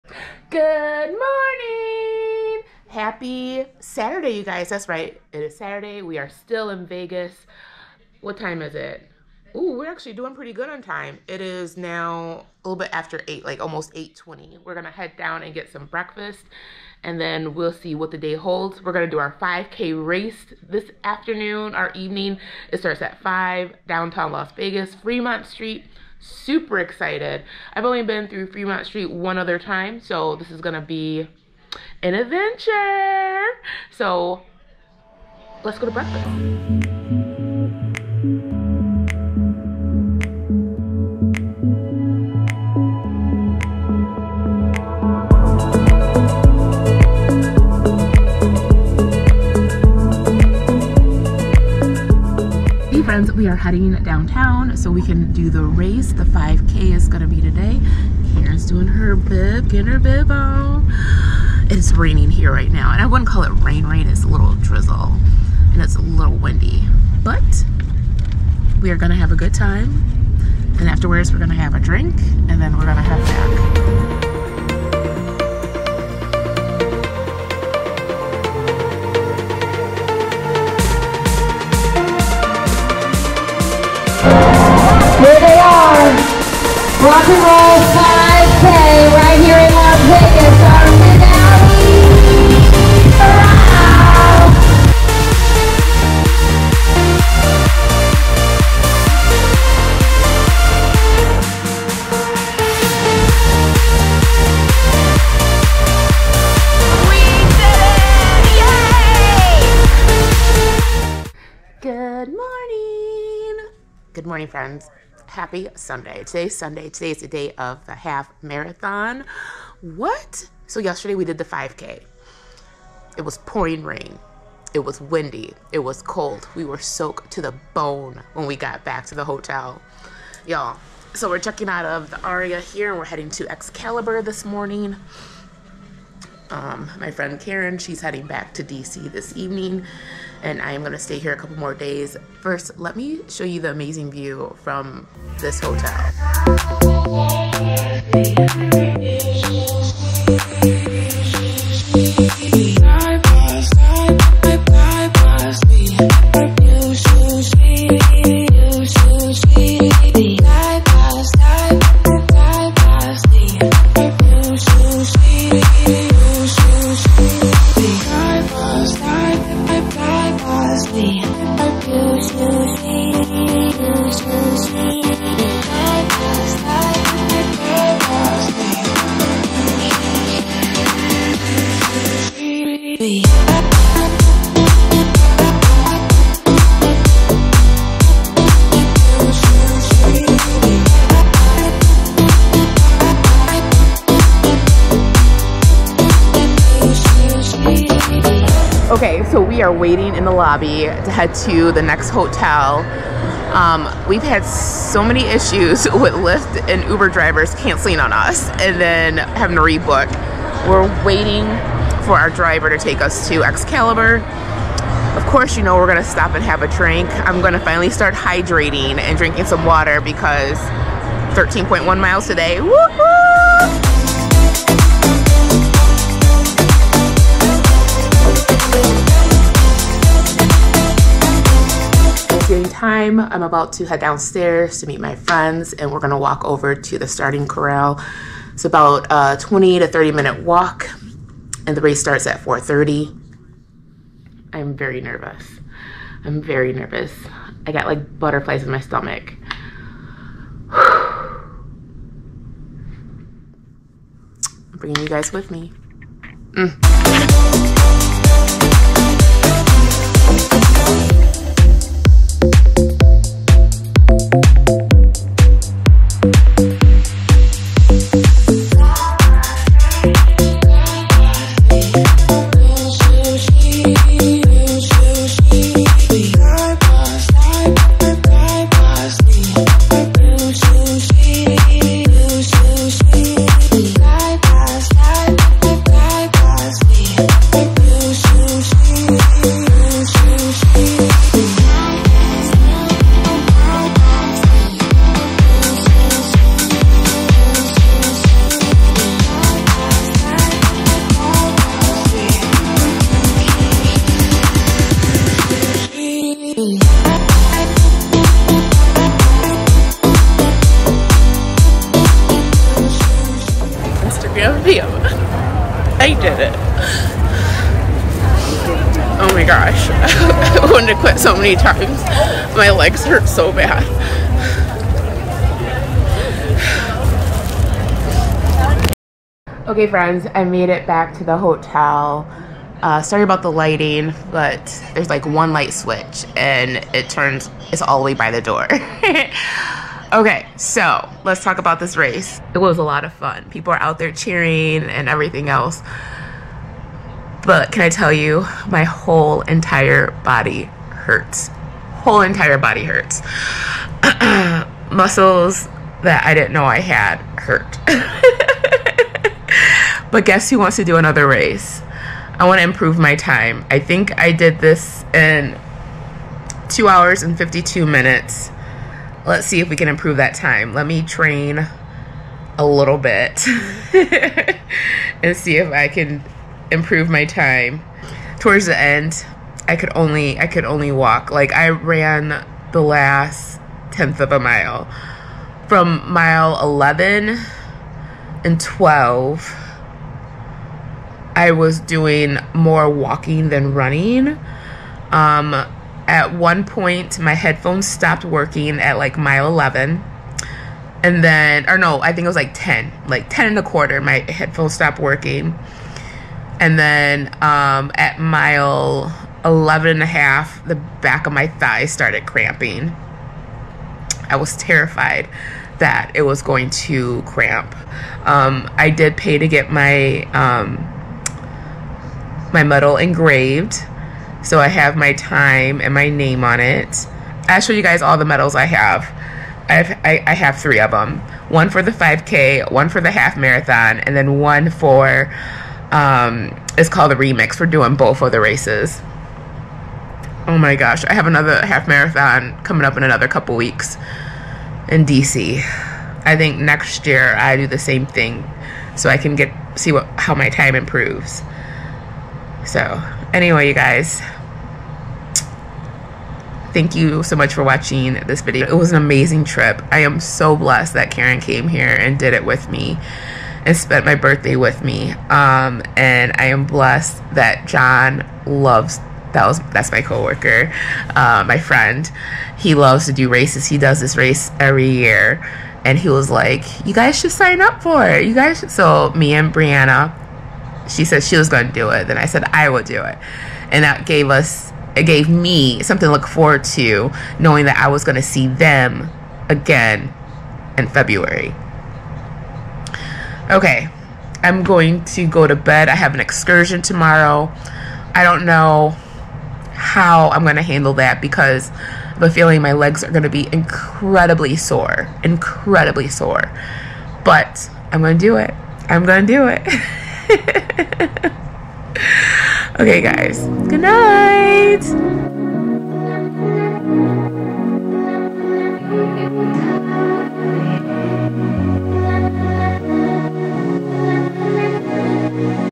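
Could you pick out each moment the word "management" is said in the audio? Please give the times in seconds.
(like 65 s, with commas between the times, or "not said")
not said.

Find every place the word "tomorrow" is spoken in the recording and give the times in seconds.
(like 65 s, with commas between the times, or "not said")
496 s.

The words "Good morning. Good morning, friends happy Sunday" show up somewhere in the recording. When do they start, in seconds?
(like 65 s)
111 s.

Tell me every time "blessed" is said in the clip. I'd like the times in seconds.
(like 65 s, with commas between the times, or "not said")
460 s, 466 s.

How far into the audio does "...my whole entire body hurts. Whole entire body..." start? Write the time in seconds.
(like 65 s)
348 s.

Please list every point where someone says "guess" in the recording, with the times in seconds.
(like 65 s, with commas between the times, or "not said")
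360 s.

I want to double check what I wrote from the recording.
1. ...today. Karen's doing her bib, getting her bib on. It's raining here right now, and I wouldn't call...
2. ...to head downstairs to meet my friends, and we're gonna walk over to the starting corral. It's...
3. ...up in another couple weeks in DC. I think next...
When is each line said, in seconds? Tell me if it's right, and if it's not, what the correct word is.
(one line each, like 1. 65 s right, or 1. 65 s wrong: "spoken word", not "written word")
1. 57 s right
2. 233 s right
3. 442 s right.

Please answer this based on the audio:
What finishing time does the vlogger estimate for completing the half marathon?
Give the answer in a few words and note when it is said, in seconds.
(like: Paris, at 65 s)
2 hours and 52 minutes, at 366 s.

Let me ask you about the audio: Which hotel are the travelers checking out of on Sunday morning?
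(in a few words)
Aria.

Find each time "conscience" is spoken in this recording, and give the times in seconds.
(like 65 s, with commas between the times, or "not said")
not said.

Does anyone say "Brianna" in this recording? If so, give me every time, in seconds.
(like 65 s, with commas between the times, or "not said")
479 s.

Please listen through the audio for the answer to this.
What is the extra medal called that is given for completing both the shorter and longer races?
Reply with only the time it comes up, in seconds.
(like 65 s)
437 s.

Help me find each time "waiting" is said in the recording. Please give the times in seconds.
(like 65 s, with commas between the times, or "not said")
199 s, 211 s.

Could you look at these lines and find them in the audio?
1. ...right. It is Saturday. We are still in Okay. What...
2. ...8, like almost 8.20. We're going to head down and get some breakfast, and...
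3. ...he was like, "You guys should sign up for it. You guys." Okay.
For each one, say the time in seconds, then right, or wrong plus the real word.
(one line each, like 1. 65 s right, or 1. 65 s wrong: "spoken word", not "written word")
1. 4 s wrong: "Vegas", not "Okay"
2. 13 s right
3. 475 s wrong: "Should", not "Okay".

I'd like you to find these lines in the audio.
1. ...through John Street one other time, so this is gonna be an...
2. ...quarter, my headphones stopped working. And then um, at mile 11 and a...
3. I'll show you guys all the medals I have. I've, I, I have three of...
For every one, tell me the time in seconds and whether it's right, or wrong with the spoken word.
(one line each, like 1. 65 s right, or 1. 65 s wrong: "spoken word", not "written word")
1. 28 s wrong: "Fremont", not "John"
2. 403 s right
3. 427 s right.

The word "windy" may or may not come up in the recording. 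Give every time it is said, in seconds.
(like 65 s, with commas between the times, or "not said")
66 s, 124 s.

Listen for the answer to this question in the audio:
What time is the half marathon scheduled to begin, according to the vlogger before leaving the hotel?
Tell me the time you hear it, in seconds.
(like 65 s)
242 s.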